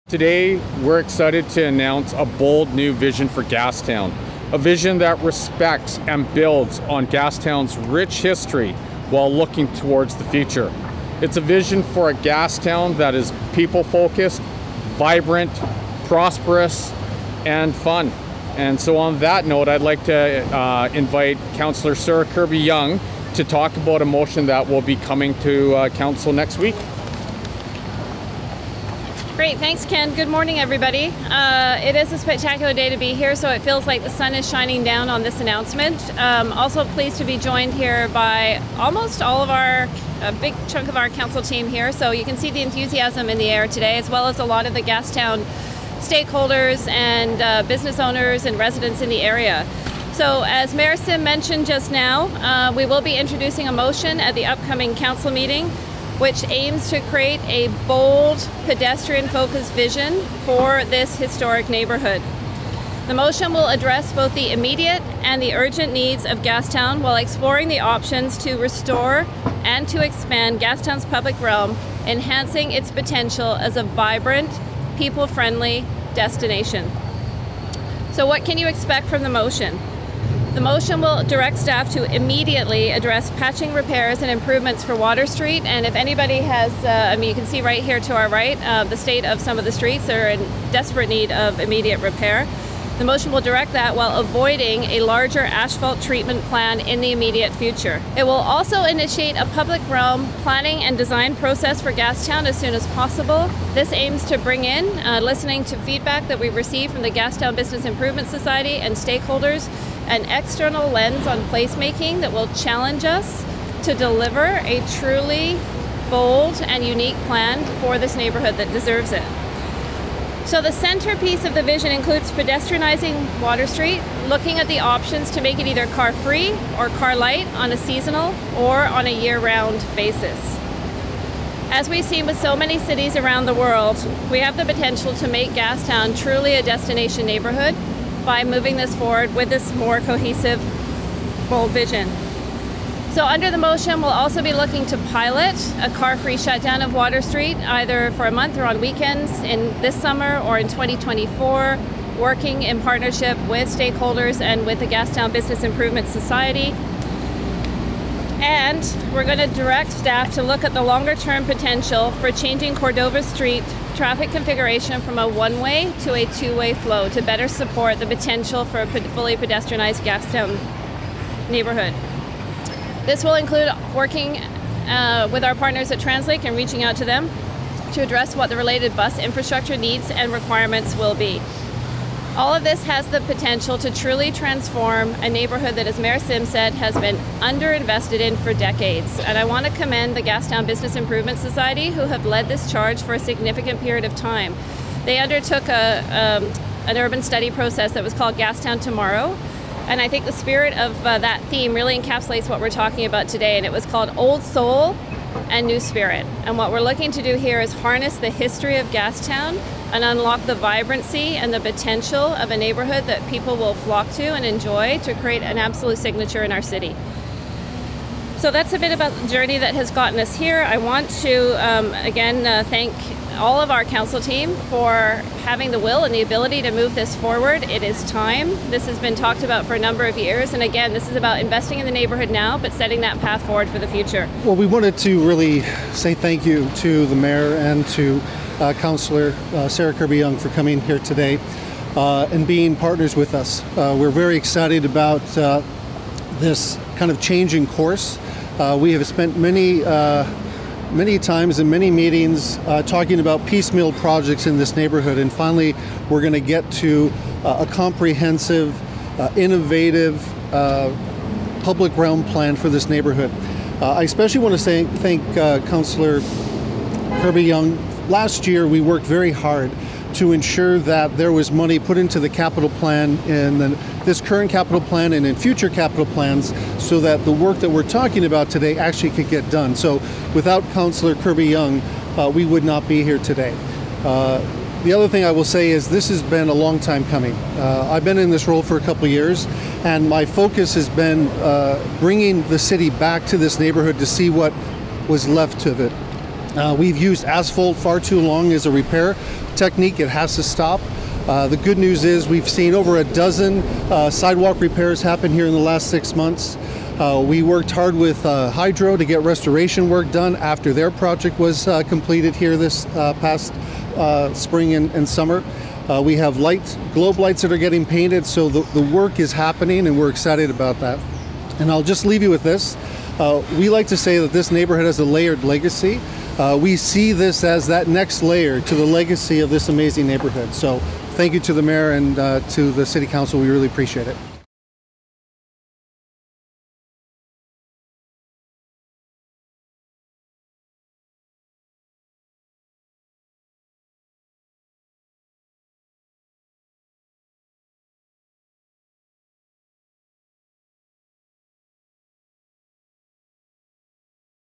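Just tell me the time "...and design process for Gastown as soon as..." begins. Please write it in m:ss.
1:40.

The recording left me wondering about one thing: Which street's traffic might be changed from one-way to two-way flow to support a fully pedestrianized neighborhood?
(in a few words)
Cordova Street.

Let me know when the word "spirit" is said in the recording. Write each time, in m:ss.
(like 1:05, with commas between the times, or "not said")
3:20, 3:25.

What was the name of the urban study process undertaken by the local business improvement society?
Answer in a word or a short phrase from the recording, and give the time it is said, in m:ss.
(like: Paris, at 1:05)
Gastown Tomorrow, at 3:18.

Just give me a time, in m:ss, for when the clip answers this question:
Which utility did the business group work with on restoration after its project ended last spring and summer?
5:08.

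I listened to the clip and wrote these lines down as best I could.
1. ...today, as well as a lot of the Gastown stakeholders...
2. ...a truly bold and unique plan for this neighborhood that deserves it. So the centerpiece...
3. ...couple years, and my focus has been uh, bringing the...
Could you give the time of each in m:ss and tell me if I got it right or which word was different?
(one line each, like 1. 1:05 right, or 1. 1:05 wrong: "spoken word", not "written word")
1. 0:43 right
2. 1:54 right
3. 4:48 right.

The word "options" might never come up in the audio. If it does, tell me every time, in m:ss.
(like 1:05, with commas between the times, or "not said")
1:07, 2:04.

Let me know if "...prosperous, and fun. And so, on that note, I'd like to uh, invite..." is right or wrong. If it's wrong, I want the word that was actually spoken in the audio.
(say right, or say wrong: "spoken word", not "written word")
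right.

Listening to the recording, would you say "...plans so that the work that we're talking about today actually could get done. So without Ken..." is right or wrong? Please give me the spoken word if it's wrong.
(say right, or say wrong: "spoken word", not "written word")
wrong: "Councillor", not "Ken".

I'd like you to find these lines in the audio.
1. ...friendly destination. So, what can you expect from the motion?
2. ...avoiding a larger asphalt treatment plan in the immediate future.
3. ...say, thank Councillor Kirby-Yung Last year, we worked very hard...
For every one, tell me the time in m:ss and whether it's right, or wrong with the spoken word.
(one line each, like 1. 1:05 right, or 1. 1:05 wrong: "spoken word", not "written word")
1. 1:15 right
2. 1:34 right
3. 4:24 right.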